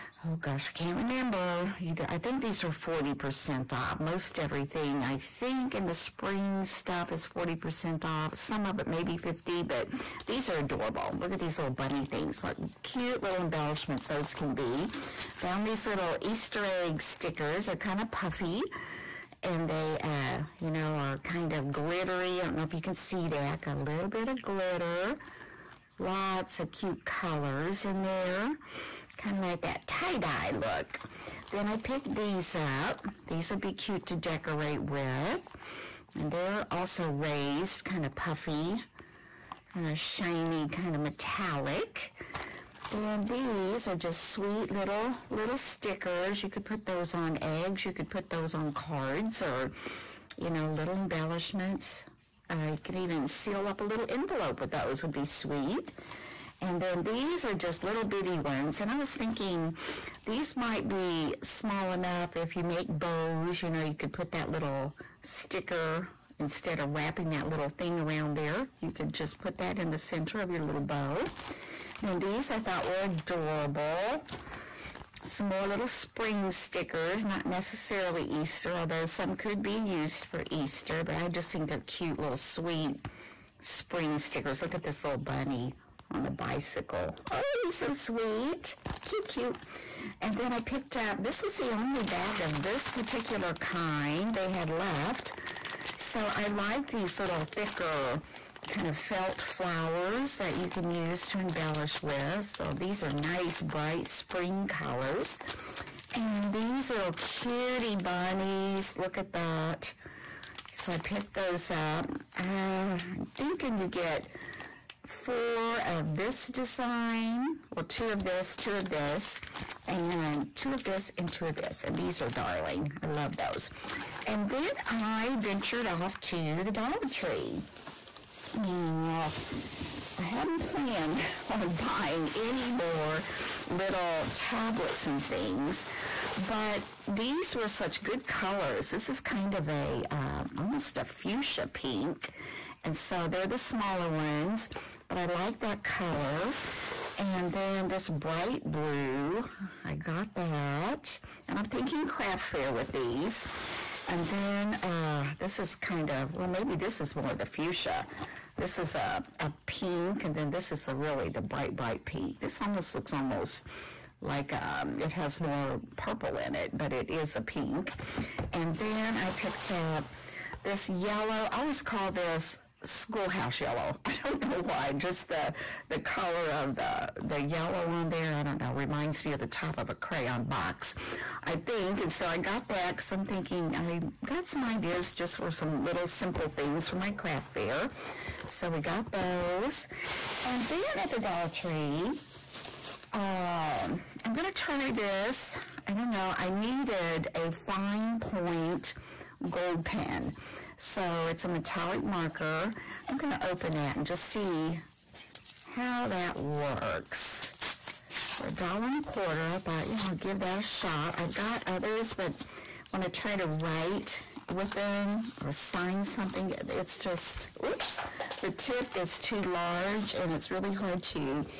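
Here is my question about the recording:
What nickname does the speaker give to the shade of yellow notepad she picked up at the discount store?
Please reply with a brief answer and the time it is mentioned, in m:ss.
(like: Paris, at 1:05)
schoolhouse yellow, at 2:52.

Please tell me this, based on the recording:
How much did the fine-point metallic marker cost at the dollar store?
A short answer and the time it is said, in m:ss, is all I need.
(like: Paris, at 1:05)
a dollar and a quarter, at 3:28.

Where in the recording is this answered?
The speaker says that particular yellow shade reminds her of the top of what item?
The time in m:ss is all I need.
2:59.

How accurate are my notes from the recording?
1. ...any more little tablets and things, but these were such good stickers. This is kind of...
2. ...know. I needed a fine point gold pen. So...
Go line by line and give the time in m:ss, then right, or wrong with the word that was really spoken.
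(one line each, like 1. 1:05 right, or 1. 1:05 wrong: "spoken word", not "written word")
1. 2:12 wrong: "colors", not "stickers"
2. 3:16 right.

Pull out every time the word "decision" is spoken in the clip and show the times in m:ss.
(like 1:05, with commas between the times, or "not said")
not said.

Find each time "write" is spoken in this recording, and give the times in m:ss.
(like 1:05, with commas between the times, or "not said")
3:33.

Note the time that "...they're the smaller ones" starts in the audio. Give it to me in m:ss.
2:23.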